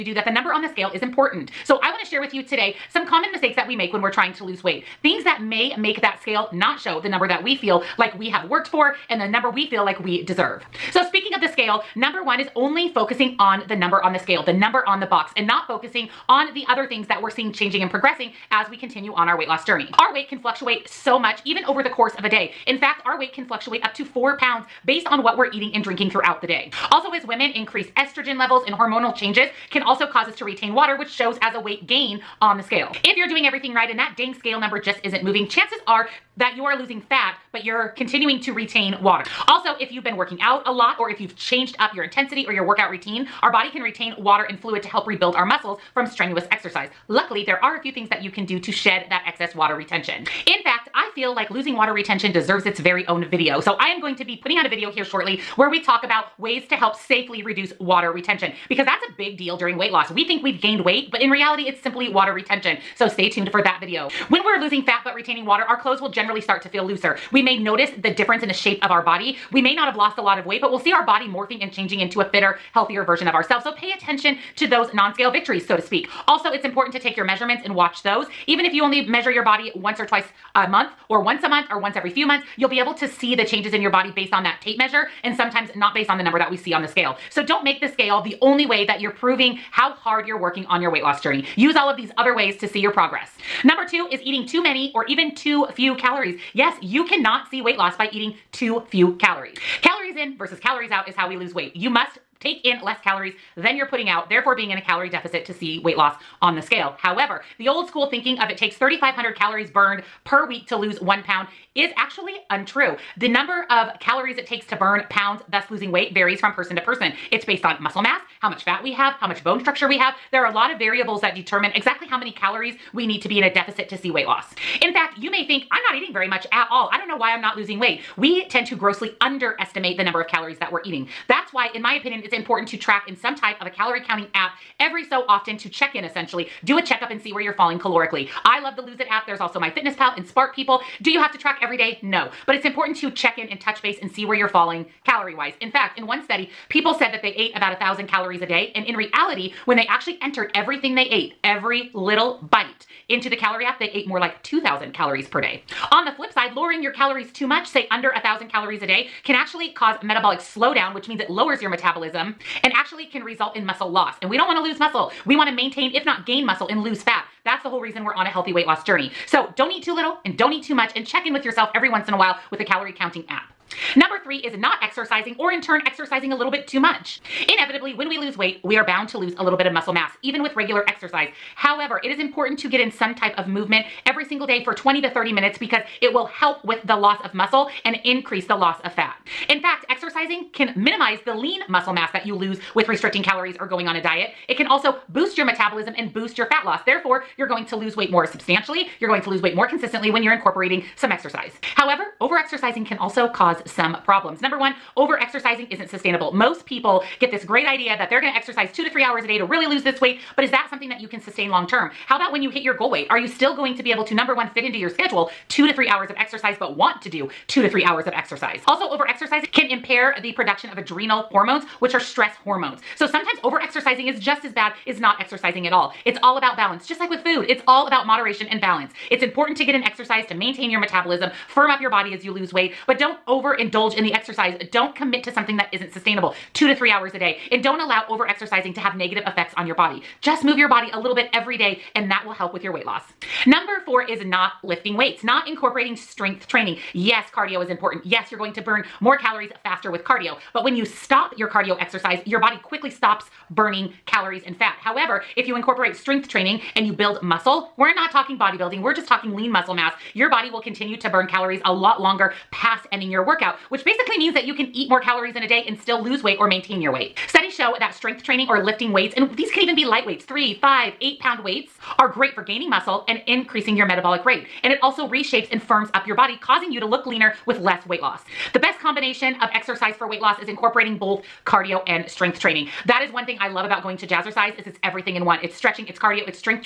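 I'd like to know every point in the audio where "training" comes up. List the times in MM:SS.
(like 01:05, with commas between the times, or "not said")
04:06, 04:16, 04:28, 04:42.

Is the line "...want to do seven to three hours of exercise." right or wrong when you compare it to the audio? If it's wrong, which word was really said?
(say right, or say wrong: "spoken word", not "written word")
wrong: "two", not "seven".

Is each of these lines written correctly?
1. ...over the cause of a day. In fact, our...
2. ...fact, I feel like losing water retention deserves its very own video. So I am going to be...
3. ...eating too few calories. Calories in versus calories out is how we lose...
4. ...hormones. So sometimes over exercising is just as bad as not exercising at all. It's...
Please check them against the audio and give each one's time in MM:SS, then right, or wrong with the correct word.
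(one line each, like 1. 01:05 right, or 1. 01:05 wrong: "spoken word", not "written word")
1. 00:21 wrong: "course", not "cause"
2. 00:50 right
3. 01:38 right
4. 03:42 right.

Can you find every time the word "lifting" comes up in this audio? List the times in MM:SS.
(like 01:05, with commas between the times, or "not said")
04:04, 04:28.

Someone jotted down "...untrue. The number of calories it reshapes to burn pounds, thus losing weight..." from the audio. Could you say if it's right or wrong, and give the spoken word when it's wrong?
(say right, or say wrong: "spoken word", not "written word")
wrong: "takes", not "reshapes".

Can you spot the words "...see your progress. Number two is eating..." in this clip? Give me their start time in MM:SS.
01:32.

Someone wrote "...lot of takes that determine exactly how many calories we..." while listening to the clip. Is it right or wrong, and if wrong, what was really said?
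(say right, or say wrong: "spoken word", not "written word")
wrong: "variables", not "takes".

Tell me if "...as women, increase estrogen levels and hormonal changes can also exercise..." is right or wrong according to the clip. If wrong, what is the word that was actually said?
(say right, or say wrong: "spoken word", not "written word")
wrong: "cause", not "exercise".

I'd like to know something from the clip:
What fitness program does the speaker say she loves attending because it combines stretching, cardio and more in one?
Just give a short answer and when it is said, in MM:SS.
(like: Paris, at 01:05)
Jazzercise, at 04:44.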